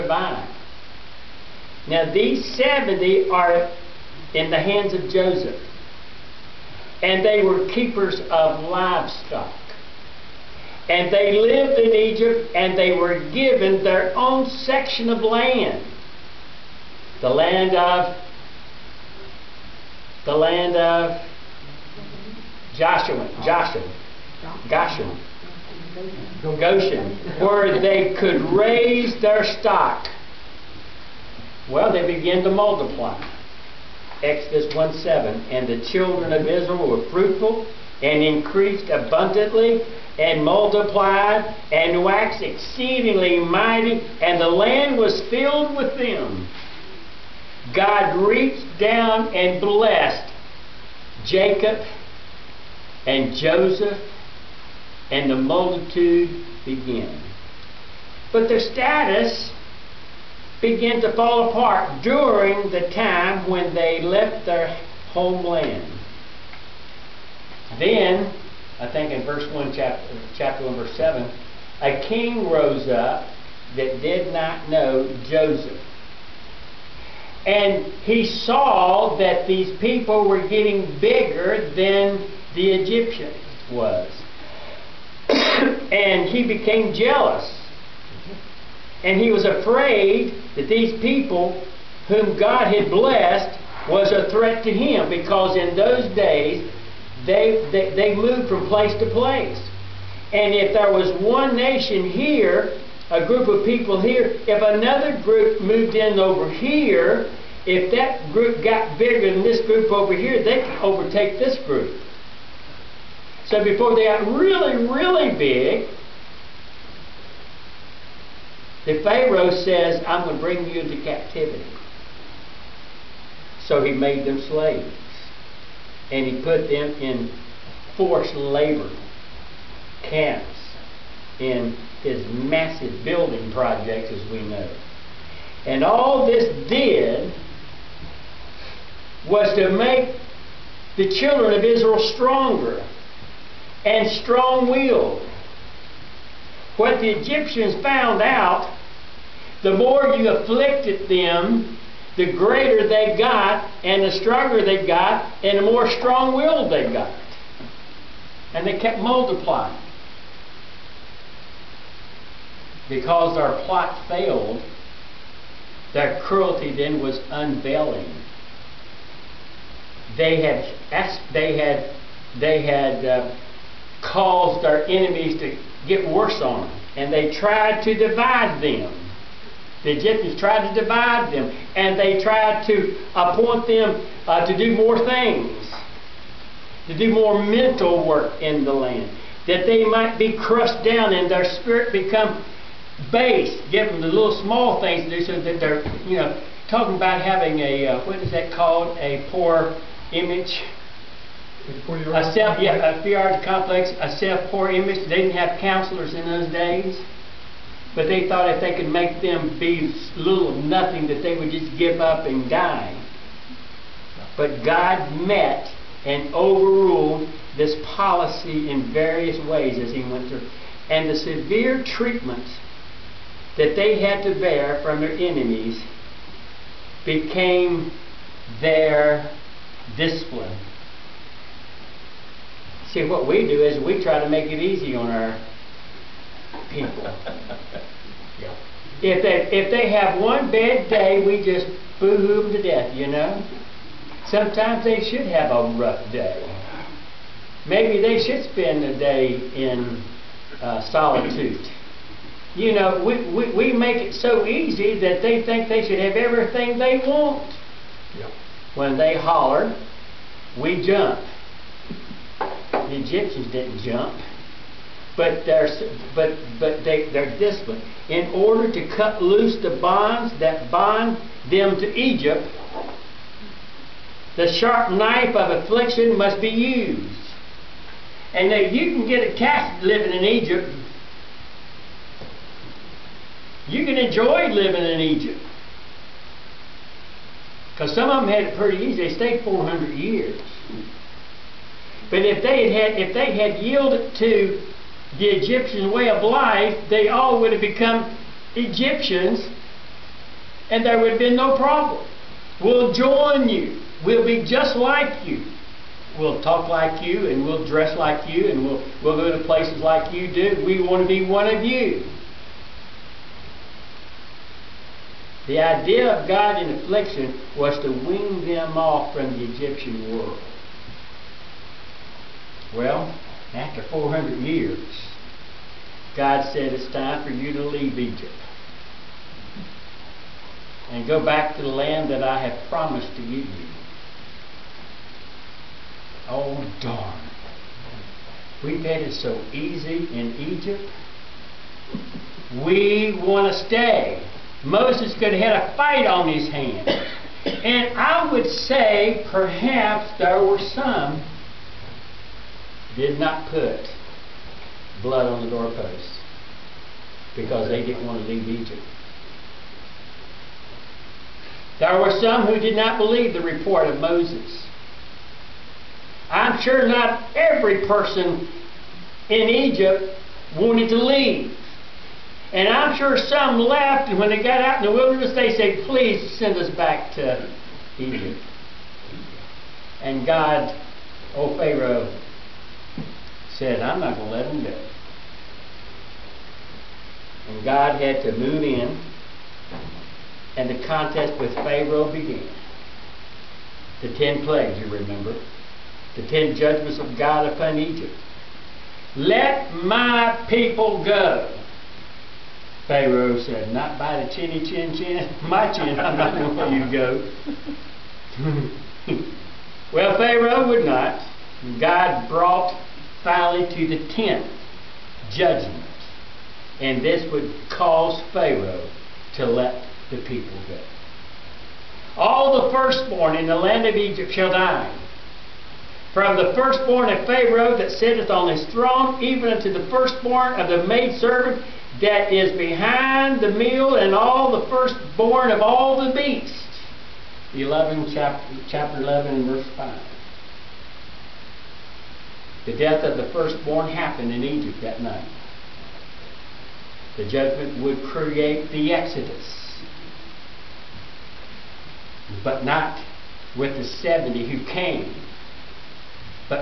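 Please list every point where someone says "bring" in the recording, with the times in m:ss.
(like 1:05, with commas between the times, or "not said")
2:00.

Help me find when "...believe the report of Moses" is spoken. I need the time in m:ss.
6:02.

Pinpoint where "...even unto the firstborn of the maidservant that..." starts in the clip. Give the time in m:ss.
7:09.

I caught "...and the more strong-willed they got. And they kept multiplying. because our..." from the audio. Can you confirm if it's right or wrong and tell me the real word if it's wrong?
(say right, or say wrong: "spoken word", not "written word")
right.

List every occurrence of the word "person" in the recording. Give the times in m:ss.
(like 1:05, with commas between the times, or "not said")
6:07.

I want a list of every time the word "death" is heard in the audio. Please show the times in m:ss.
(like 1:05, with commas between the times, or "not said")
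4:02, 7:22.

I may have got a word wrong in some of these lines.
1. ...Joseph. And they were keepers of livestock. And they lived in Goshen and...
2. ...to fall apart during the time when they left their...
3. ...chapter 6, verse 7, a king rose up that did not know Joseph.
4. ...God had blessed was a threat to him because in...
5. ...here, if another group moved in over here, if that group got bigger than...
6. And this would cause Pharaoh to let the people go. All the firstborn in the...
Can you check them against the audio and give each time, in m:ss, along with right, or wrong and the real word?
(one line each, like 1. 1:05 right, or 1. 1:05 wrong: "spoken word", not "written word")
1. 0:05 wrong: "Egypt", not "Goshen"
2. 1:01 right
3. 1:10 wrong: "1", not "6"
4. 1:32 right
5. 1:44 right
6. 6:56 right.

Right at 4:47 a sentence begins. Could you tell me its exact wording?
Because some of them had it pretty easy.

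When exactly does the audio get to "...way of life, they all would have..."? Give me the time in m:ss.
4:55.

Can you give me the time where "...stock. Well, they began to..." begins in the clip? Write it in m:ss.
0:29.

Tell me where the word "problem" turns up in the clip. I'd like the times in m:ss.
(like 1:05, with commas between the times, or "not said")
5:01.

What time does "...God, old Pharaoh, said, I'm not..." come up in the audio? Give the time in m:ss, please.
6:20.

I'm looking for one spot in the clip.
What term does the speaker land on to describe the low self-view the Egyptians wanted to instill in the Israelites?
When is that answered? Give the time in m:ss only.
3:23.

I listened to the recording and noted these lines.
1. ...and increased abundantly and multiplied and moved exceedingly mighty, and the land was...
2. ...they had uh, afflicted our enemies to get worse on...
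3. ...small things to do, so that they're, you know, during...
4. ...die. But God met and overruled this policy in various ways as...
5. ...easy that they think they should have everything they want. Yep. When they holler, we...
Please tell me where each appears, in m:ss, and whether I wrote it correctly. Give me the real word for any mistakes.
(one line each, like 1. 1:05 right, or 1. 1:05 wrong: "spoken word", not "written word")
1. 0:38 wrong: "waxed", not "moved"
2. 2:52 wrong: "caused", not "afflicted"
3. 3:14 wrong: "talking", not "during"
4. 3:32 right
5. 4:14 right.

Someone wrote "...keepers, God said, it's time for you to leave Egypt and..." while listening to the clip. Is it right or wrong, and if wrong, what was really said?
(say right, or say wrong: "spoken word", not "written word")
wrong: "years", not "keepers".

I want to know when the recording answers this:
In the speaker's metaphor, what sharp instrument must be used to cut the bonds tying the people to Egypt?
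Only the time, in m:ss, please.
4:34.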